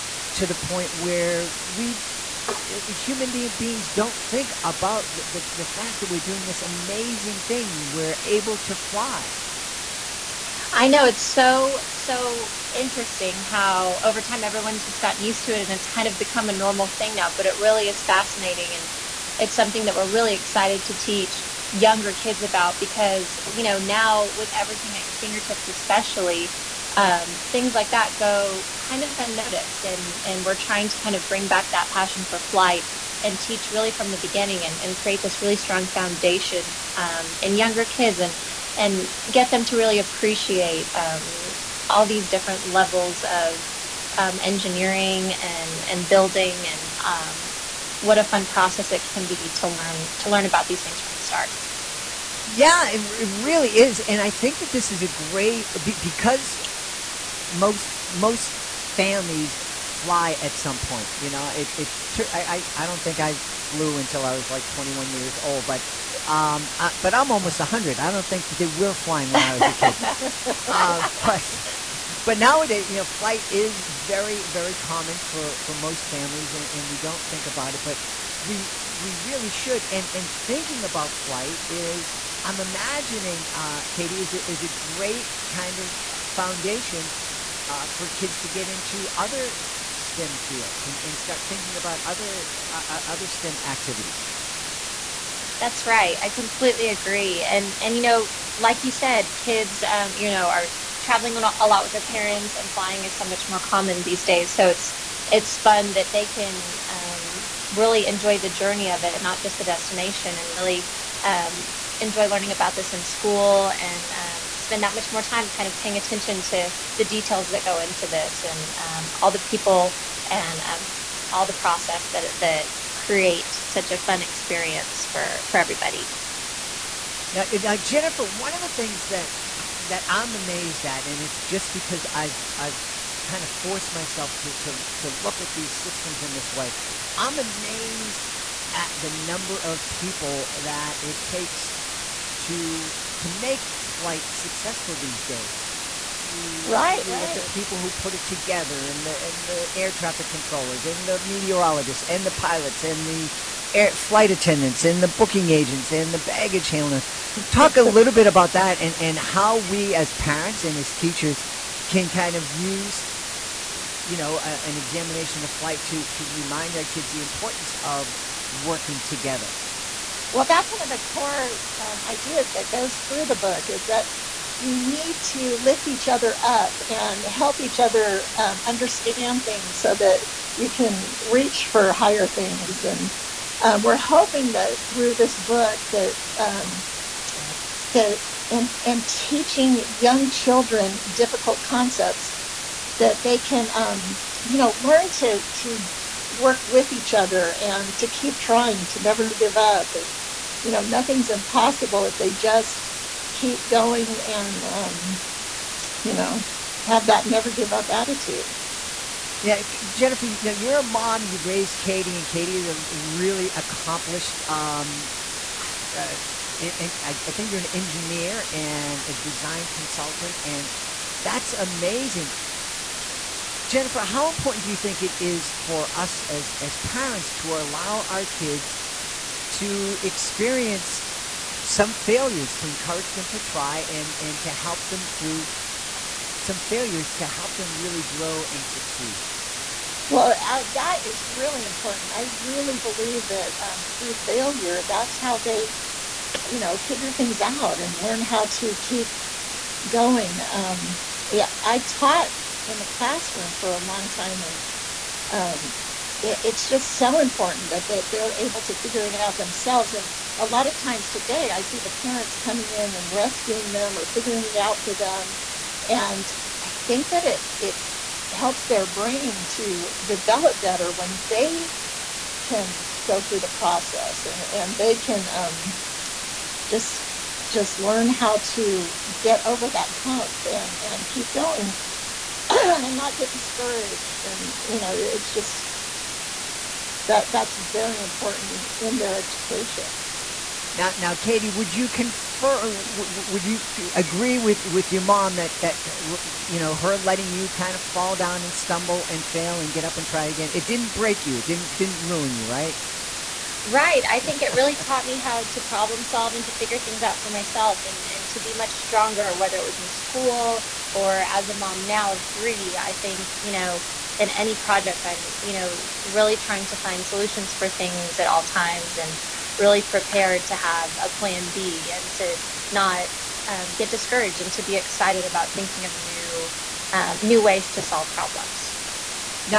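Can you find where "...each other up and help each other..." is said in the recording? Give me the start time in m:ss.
2:55.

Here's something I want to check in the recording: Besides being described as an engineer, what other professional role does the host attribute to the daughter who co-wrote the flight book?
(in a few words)
design consultant.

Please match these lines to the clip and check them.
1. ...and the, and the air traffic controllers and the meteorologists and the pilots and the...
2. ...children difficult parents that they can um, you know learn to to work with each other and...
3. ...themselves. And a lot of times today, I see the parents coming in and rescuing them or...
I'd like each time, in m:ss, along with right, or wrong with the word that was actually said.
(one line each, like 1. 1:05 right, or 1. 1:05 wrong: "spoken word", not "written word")
1. 2:28 right
2. 3:10 wrong: "concepts", not "parents"
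3. 4:19 right.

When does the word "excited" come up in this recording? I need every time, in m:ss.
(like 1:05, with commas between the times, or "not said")
0:20, 5:24.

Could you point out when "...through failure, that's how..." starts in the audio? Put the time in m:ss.
4:03.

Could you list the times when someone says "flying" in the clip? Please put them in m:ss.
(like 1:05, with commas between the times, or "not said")
1:08, 1:42.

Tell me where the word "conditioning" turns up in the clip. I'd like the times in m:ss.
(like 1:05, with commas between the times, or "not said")
not said.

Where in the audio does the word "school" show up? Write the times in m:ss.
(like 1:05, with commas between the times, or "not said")
1:53, 5:09.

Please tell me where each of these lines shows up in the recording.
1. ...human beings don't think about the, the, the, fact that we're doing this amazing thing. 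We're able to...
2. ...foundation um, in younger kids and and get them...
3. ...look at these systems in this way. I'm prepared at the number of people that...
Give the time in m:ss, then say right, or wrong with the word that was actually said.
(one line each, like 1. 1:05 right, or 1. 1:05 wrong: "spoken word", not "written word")
1. 0:02 right
2. 0:35 right
3. 2:15 wrong: "amazed", not "prepared".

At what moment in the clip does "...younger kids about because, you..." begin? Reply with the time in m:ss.
0:21.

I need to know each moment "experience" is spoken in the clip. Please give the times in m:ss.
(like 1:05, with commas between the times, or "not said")
2:04, 3:50.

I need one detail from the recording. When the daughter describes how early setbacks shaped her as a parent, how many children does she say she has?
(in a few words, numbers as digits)
3.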